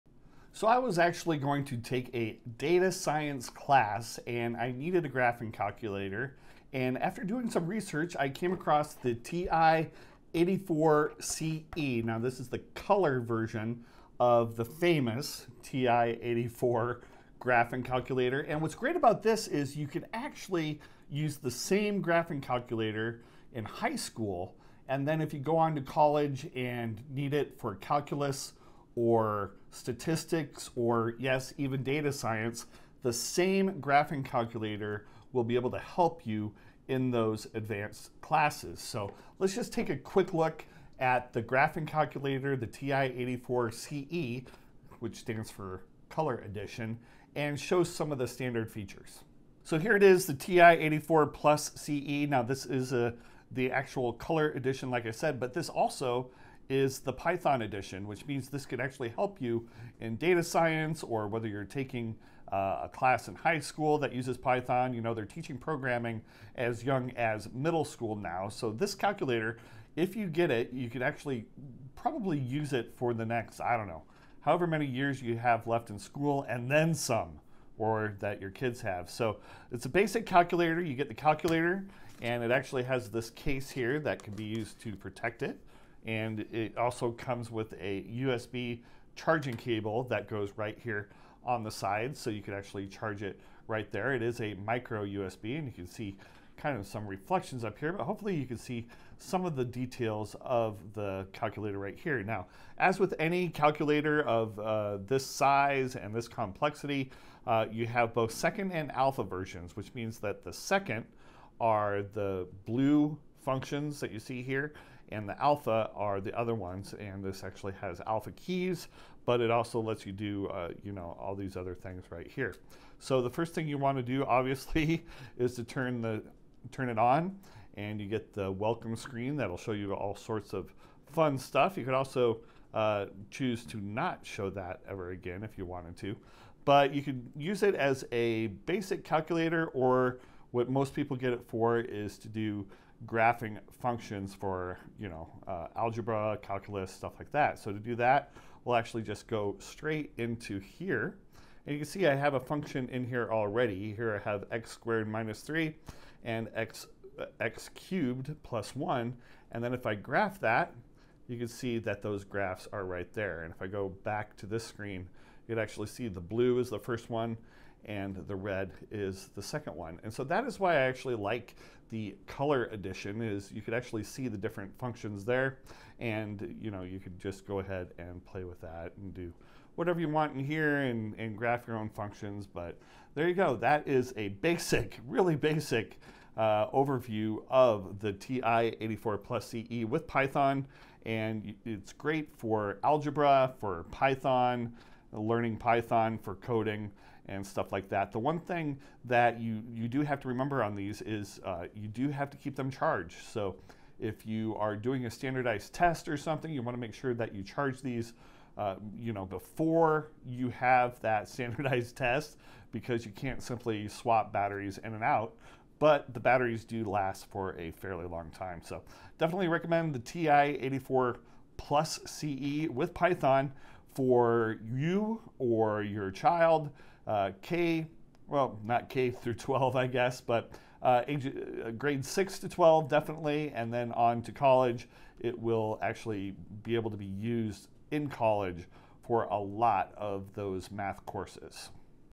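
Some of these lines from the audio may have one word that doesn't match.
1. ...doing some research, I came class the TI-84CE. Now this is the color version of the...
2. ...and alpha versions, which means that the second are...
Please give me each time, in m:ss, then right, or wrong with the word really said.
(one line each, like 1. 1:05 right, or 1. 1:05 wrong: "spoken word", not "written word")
1. 0:07 wrong: "across", not "class"
2. 1:48 right.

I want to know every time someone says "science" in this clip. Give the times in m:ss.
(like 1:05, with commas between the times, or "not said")
0:02, 0:32, 1:00.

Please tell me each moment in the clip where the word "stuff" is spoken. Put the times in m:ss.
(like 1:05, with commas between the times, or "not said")
2:11, 2:26, 3:17.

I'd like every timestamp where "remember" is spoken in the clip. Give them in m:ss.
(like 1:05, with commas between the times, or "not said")
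3:20.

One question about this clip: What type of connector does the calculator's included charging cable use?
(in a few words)
micro USB.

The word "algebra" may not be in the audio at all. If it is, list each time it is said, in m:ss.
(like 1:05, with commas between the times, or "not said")
2:25, 3:12.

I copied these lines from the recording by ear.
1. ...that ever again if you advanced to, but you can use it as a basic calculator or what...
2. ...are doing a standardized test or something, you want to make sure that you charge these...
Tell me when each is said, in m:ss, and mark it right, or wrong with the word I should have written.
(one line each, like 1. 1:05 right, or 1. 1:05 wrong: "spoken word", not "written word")
1. 2:14 wrong: "wanted", not "advanced"
2. 3:24 right.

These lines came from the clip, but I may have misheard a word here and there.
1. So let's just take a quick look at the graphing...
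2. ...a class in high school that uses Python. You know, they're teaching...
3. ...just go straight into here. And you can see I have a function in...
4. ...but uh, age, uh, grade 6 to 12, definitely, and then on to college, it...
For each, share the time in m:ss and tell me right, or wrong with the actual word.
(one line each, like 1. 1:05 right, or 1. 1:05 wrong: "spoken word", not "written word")
1. 0:38 right
2. 1:02 right
3. 2:29 right
4. 3:50 right.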